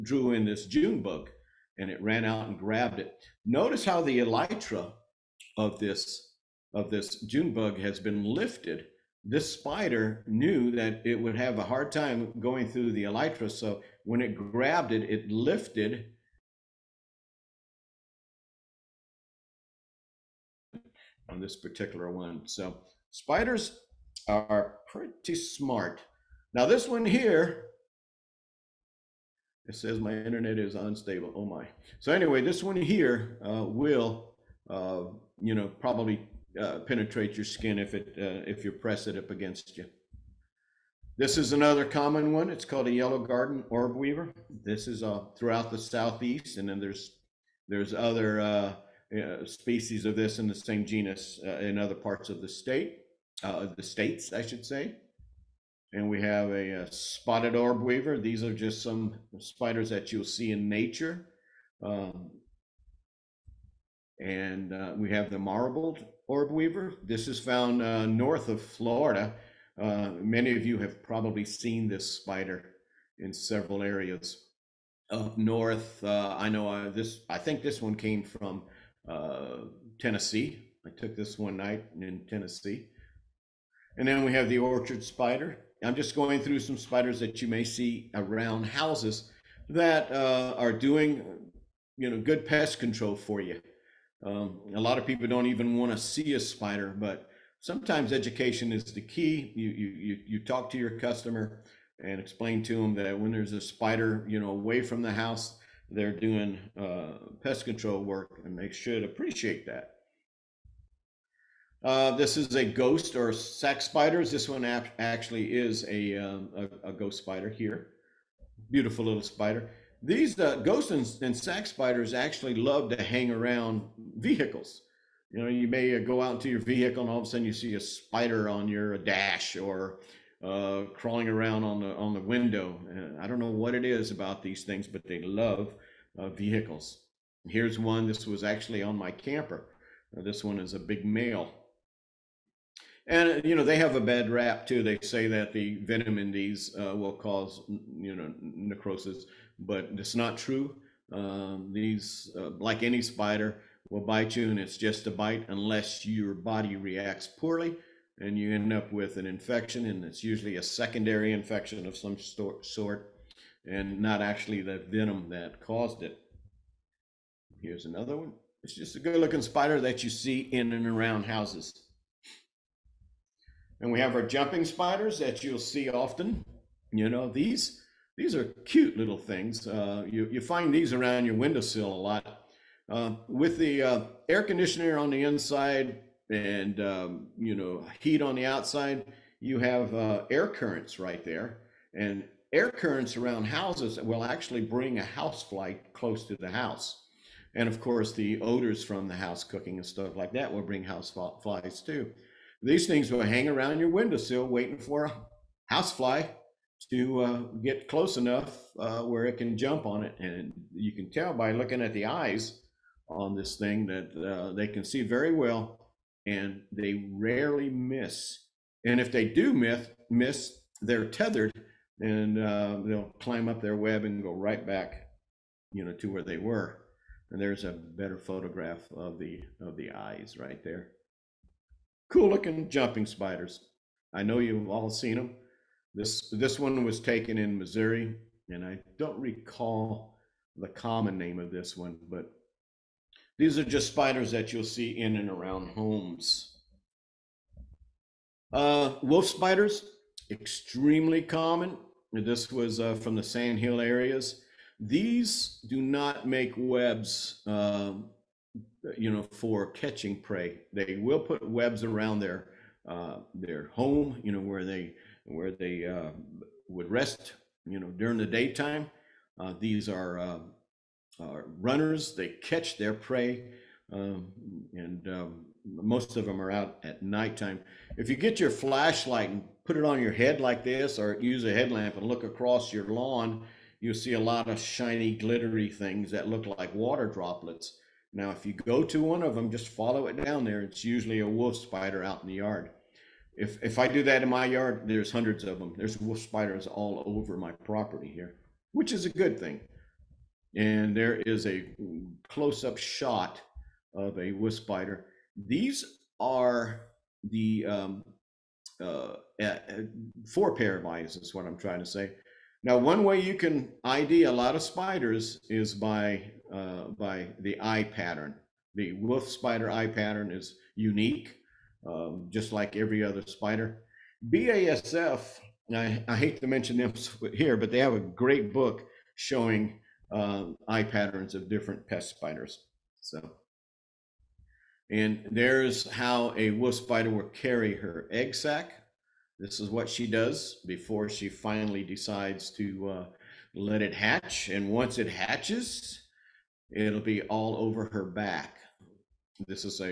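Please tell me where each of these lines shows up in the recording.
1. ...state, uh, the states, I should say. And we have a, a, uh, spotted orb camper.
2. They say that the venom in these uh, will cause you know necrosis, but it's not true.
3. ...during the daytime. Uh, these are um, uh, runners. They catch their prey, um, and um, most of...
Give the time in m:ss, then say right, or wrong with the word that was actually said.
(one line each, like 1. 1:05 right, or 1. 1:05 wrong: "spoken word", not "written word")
1. 0:52 wrong: "weaver", not "camper"
2. 2:24 right
3. 4:27 right.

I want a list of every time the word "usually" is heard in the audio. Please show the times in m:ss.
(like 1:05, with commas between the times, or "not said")
2:40, 4:50.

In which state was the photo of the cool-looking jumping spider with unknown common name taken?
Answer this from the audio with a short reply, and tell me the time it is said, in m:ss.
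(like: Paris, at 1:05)
Missouri, at 3:57.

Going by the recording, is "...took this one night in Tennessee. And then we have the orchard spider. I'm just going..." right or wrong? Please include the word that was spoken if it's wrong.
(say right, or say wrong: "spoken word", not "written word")
right.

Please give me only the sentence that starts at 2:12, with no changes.
And uh, I don't know what it is about these things, but they love uh, vehicles.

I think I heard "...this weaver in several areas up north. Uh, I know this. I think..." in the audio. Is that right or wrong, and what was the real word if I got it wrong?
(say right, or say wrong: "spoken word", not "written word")
wrong: "spider", not "weaver".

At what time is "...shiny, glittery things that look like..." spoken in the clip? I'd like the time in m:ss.
4:44.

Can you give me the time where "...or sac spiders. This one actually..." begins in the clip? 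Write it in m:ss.
1:53.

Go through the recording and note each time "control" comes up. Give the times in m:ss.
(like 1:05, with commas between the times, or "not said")
1:32, 1:47.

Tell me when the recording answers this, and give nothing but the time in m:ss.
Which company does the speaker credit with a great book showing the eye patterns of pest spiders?
5:24.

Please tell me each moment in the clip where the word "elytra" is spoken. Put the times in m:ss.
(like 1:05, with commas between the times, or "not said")
0:04, 0:13.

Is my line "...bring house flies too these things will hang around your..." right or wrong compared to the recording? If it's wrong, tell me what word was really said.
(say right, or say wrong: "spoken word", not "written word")
right.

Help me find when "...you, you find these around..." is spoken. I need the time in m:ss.
3:00.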